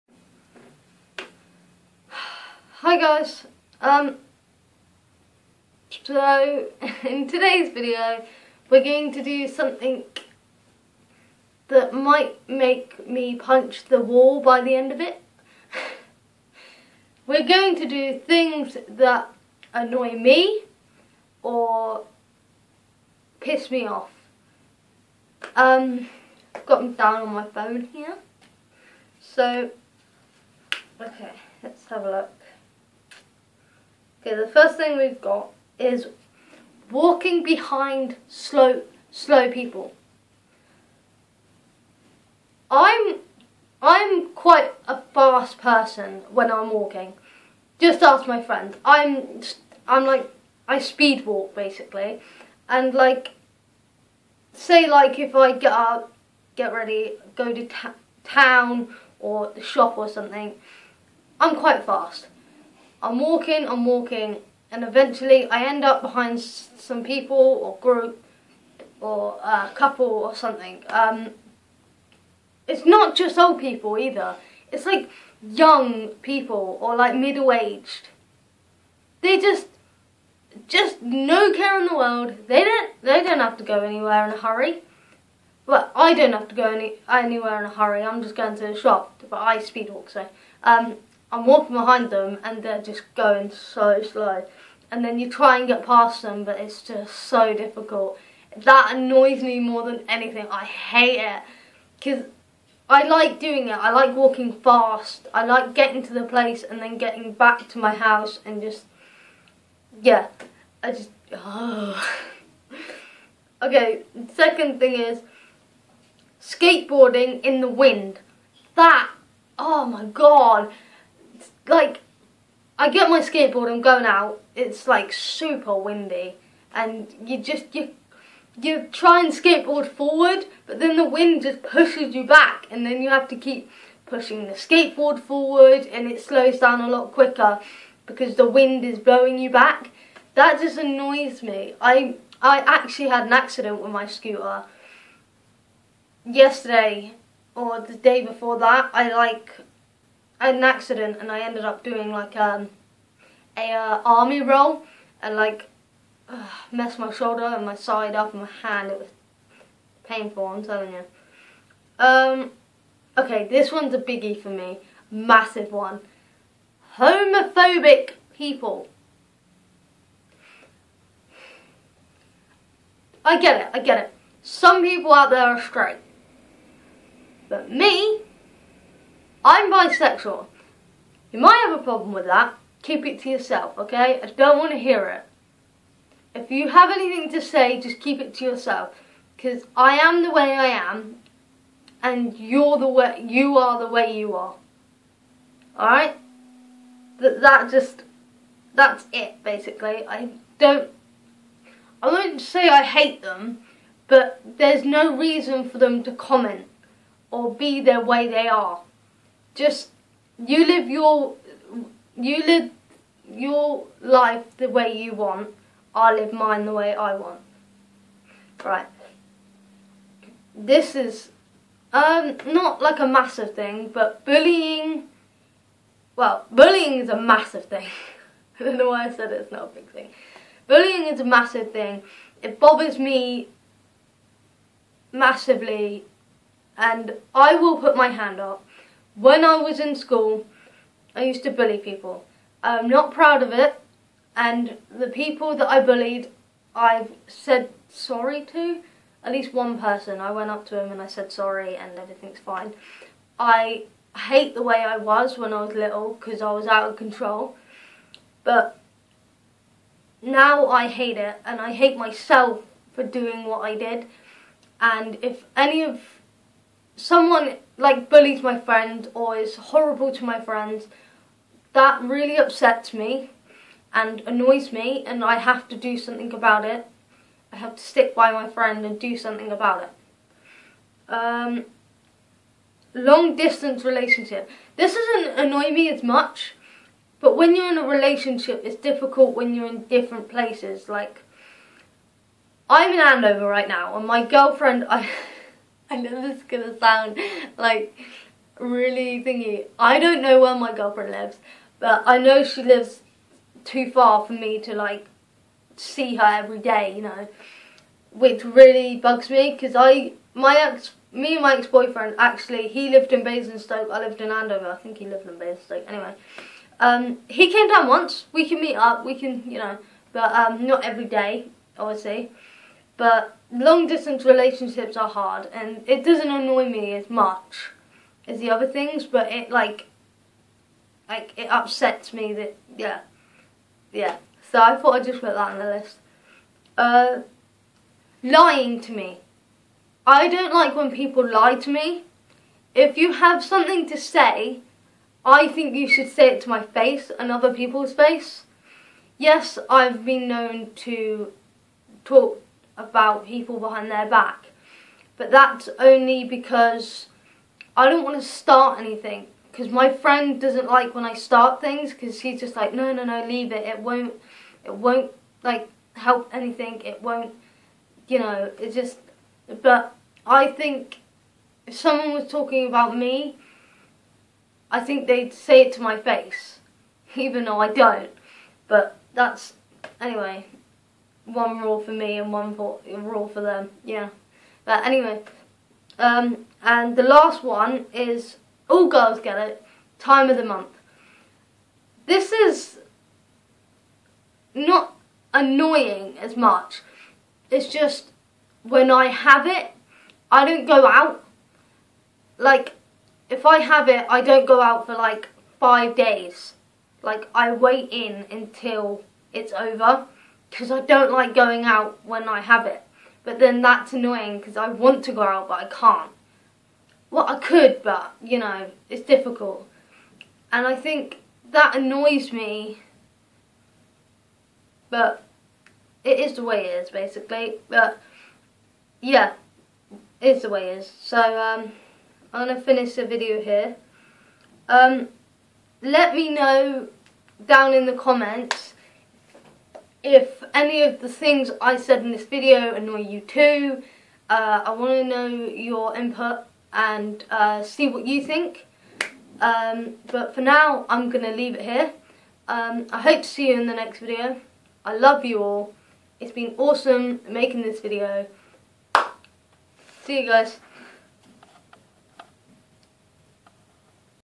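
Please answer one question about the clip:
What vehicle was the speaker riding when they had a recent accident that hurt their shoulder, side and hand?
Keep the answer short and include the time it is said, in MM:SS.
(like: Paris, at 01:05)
Scooter, at 02:24.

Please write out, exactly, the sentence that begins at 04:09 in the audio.
At least one person, I went up to him and I said sorry and everything's fine.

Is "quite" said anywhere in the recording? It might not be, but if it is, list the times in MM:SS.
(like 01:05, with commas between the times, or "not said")
00:44, 01:01.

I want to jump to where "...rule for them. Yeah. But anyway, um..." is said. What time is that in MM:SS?
06:22.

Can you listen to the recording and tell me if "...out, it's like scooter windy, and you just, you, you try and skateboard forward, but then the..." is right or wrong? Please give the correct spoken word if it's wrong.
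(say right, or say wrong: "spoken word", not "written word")
wrong: "super", not "scooter".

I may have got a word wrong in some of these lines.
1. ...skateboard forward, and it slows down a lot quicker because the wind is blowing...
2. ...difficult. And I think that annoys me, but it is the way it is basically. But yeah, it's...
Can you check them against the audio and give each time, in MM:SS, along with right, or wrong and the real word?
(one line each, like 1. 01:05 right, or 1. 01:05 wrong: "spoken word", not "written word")
1. 02:14 right
2. 06:59 right.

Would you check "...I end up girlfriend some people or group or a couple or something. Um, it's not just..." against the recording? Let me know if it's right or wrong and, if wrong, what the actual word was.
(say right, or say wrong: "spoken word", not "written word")
wrong: "behind", not "girlfriend".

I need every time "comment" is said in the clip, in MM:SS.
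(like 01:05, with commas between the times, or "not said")
03:26, 07:17.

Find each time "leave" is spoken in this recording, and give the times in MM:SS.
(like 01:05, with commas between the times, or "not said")
06:03, 07:31.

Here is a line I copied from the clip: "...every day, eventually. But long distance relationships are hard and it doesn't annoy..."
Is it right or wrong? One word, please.
wrong.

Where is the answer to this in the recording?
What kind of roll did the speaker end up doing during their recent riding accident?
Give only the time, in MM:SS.
02:34.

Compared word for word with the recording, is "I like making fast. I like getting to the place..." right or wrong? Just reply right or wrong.
wrong.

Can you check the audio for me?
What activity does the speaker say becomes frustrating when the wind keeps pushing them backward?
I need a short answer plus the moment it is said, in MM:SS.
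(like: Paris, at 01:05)
Skateboarding, at 01:56.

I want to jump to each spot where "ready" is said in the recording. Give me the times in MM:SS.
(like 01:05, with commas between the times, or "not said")
00:56.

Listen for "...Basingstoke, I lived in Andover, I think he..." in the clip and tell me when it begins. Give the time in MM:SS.
05:13.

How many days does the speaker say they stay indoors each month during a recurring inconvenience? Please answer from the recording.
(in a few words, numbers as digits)
5.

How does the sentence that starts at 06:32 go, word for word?
This is not annoying as much.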